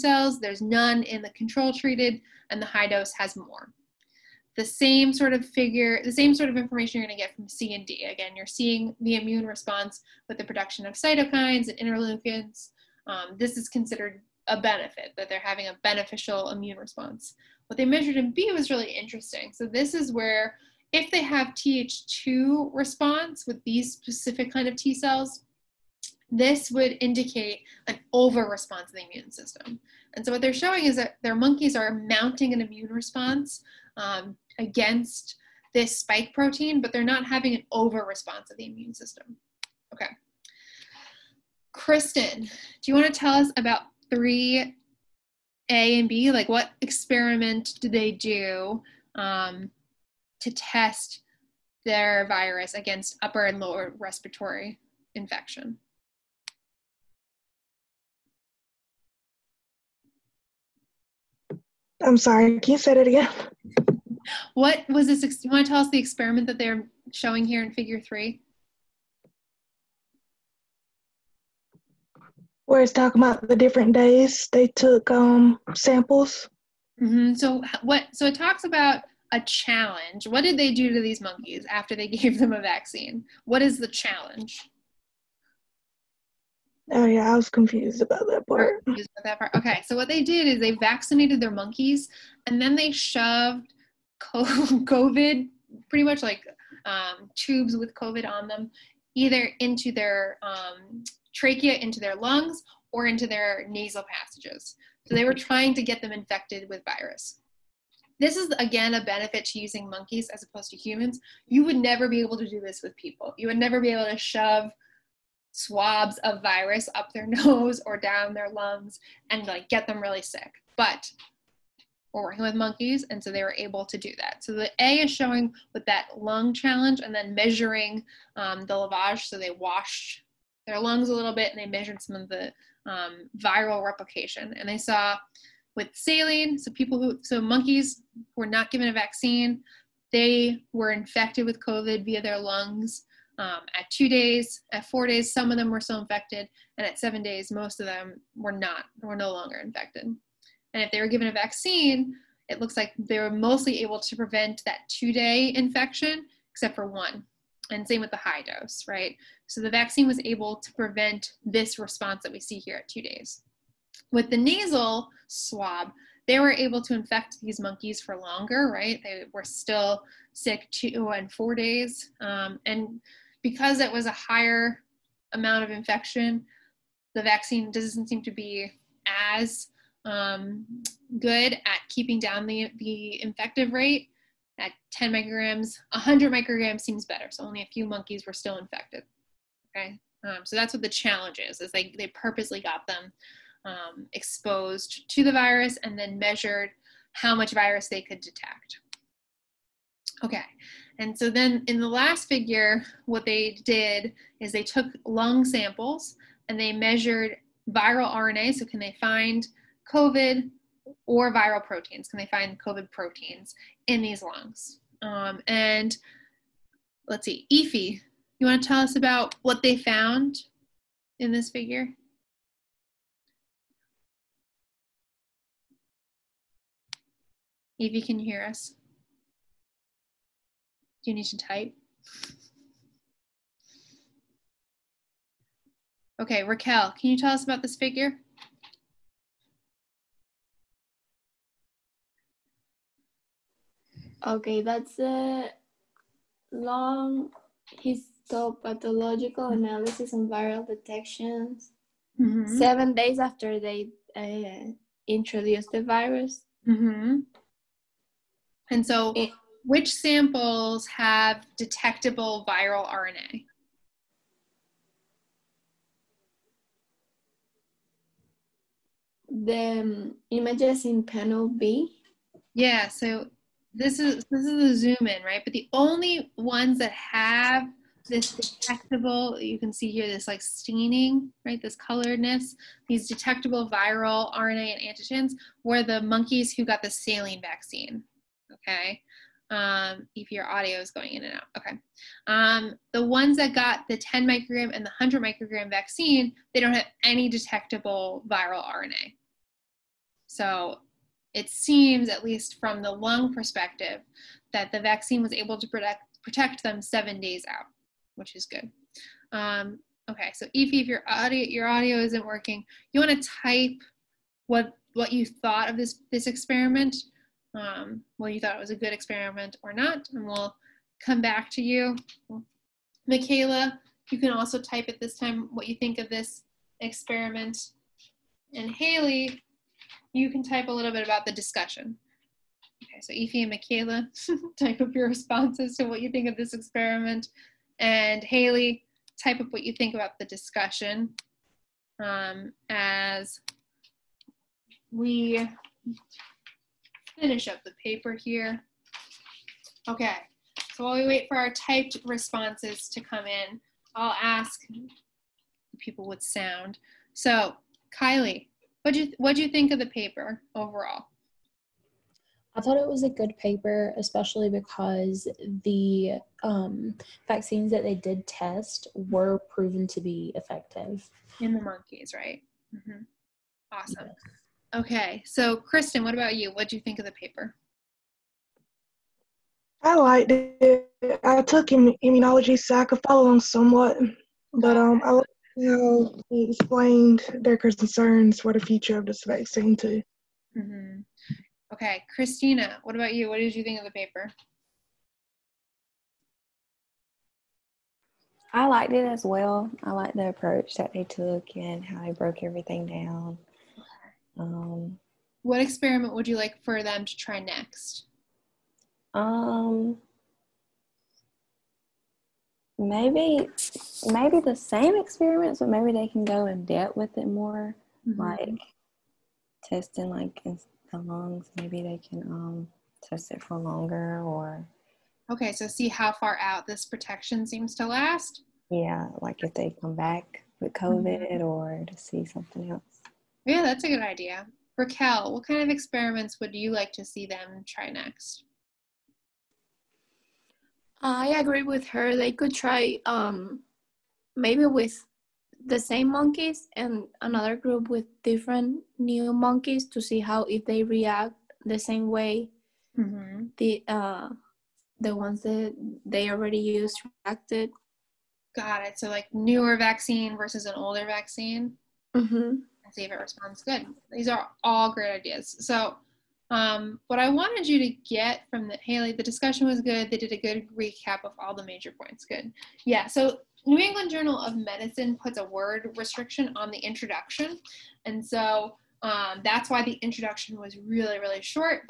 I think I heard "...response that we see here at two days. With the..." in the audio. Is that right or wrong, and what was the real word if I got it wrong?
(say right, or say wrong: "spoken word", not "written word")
right.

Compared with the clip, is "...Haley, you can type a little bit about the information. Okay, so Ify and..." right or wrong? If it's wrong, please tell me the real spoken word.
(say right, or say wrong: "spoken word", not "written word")
wrong: "discussion", not "information".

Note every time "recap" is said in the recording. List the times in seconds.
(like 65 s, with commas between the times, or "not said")
470 s.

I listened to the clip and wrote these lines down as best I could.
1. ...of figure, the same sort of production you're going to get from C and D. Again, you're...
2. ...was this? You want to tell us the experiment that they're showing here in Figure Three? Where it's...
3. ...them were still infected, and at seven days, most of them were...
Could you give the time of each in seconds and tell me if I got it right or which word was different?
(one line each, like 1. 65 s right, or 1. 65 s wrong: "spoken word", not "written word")
1. 5 s wrong: "information", not "production"
2. 64 s right
3. 145 s right.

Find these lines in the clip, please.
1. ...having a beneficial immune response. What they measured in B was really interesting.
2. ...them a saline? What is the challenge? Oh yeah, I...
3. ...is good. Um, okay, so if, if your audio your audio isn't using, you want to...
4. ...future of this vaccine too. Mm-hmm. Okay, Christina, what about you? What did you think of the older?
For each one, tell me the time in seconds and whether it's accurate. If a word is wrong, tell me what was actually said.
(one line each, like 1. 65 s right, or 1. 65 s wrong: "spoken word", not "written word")
1. 15 s right
2. 82 s wrong: "vaccine", not "saline"
3. 308 s wrong: "working", not "using"
4. 388 s wrong: "paper", not "older".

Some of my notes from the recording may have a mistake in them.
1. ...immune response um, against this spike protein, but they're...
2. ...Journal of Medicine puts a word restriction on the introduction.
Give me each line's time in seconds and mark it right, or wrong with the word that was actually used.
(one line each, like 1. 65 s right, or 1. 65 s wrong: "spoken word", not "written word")
1. 32 s right
2. 474 s right.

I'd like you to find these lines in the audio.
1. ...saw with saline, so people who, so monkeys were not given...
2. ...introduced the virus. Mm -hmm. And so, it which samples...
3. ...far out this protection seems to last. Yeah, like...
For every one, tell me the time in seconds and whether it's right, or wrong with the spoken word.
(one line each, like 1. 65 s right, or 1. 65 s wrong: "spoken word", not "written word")
1. 134 s right
2. 255 s right
3. 426 s right.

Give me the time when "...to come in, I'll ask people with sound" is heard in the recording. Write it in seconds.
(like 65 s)
352 s.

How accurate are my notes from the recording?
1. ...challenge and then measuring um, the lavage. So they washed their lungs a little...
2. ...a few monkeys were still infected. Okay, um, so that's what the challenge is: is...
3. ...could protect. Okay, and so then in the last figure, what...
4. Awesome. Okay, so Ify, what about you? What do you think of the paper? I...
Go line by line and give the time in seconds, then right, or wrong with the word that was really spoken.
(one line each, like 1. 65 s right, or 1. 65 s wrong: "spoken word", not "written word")
1. 126 s right
2. 187 s right
3. 198 s wrong: "detect", not "protect"
4. 373 s wrong: "Kristen", not "Ify".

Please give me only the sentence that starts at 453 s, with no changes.
the uh, the ones that they already used reacted.